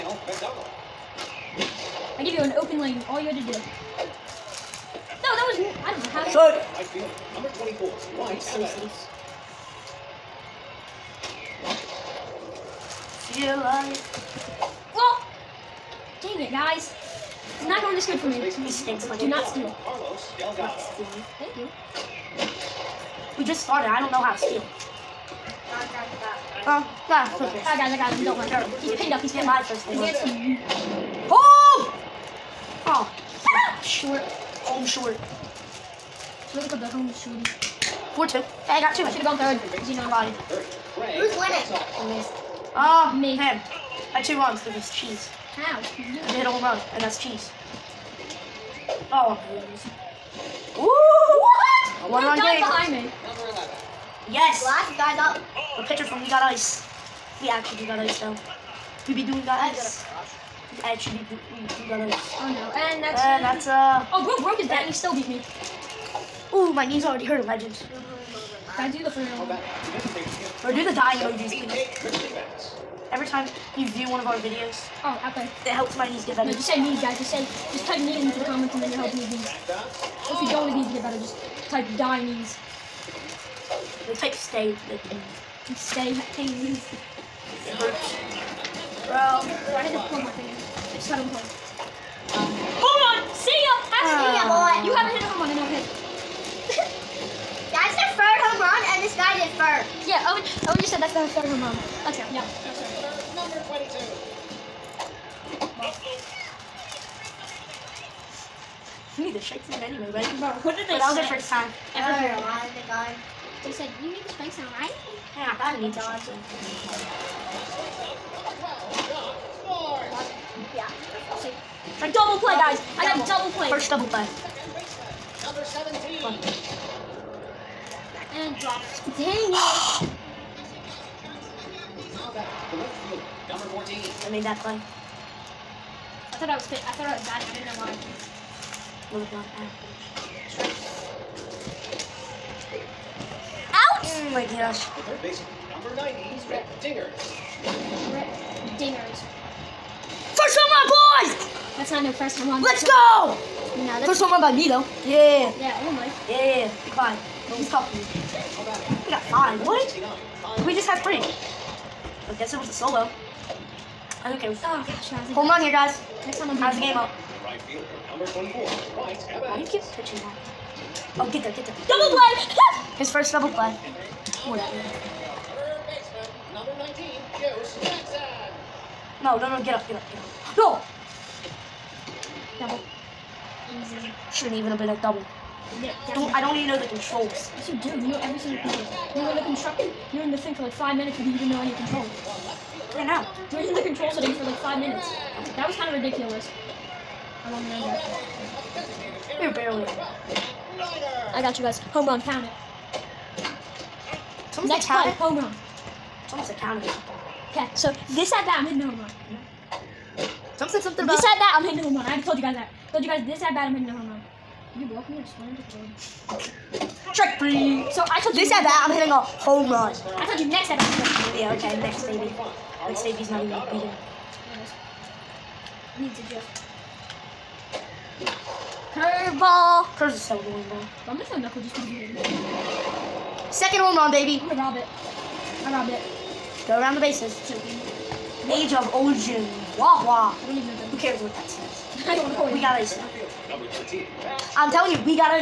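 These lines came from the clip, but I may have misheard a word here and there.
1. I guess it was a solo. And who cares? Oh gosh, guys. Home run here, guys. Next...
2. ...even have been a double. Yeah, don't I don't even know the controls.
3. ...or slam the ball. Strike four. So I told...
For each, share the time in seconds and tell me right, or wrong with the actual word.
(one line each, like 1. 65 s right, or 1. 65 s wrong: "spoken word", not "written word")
1. 161 s right
2. 184 s right
3. 215 s wrong: "three", not "four".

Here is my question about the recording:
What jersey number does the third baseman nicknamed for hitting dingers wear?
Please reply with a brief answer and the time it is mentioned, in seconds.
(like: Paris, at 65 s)
90, at 145 s.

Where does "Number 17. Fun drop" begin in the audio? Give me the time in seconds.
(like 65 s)
125 s.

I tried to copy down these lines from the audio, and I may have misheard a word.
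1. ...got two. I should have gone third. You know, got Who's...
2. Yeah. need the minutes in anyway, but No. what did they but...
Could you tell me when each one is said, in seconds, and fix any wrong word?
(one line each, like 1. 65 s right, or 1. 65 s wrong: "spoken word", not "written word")
1. 38 s right
2. 102 s wrong: "shakes", not "minutes".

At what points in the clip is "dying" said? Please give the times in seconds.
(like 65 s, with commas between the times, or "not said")
70 s, 81 s.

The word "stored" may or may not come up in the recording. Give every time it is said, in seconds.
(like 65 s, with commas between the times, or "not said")
not said.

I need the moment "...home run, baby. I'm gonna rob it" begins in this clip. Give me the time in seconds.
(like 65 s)
233 s.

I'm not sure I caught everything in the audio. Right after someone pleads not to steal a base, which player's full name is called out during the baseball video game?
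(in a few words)
Carlos Delgado.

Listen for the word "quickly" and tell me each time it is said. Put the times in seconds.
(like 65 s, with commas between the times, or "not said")
not said.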